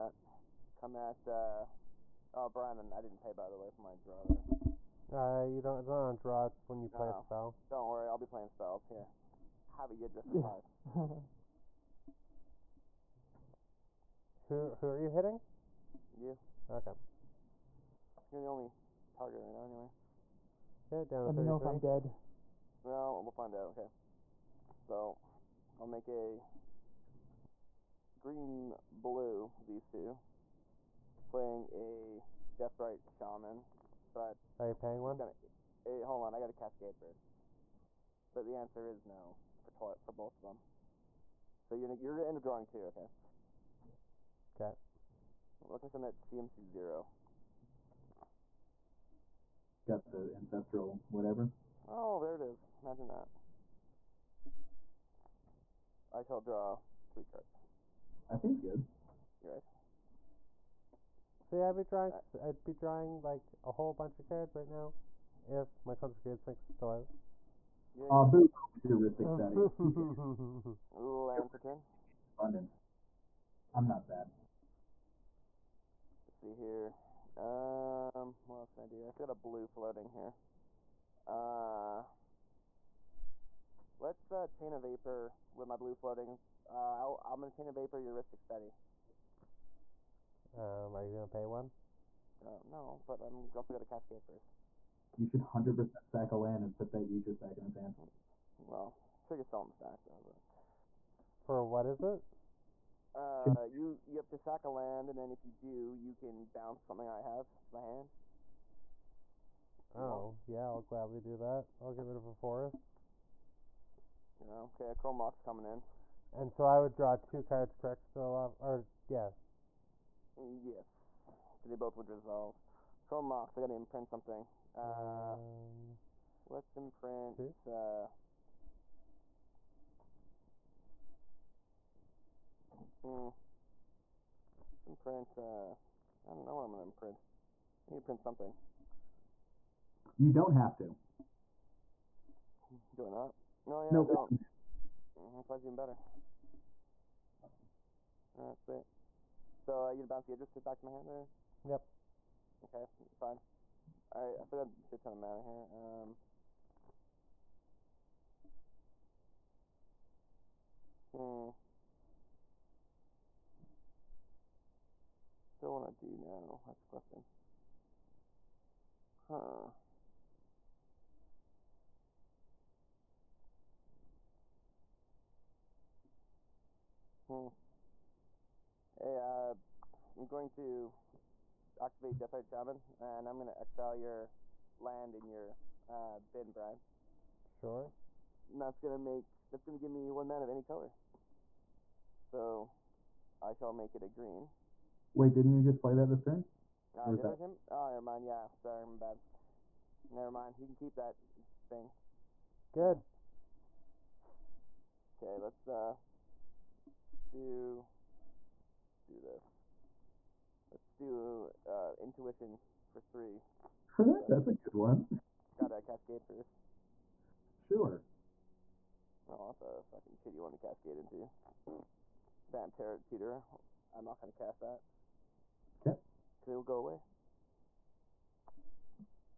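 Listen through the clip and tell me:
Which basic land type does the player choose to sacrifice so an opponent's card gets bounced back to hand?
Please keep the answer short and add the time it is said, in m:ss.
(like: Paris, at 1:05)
Forest, at 1:52.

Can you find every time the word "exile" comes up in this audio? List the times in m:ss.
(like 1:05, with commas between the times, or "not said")
3:03.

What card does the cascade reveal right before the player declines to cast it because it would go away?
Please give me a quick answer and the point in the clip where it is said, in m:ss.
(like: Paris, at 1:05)
Terror teeter, at 3:42.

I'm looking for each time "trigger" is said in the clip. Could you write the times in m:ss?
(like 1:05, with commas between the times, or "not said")
1:39.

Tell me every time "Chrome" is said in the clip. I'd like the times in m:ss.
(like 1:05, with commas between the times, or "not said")
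1:54, 2:03.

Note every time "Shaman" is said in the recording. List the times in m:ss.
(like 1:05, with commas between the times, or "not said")
0:33, 3:02.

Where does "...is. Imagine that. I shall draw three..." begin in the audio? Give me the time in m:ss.
0:52.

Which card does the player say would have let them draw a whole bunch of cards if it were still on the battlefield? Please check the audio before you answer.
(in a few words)
Consecrated Sphinx.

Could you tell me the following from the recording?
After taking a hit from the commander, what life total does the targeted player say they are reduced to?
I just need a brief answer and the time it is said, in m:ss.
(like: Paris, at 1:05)
33, at 0:21.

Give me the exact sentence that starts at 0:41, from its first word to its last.
So you're you're gonna end up drawing two, okay?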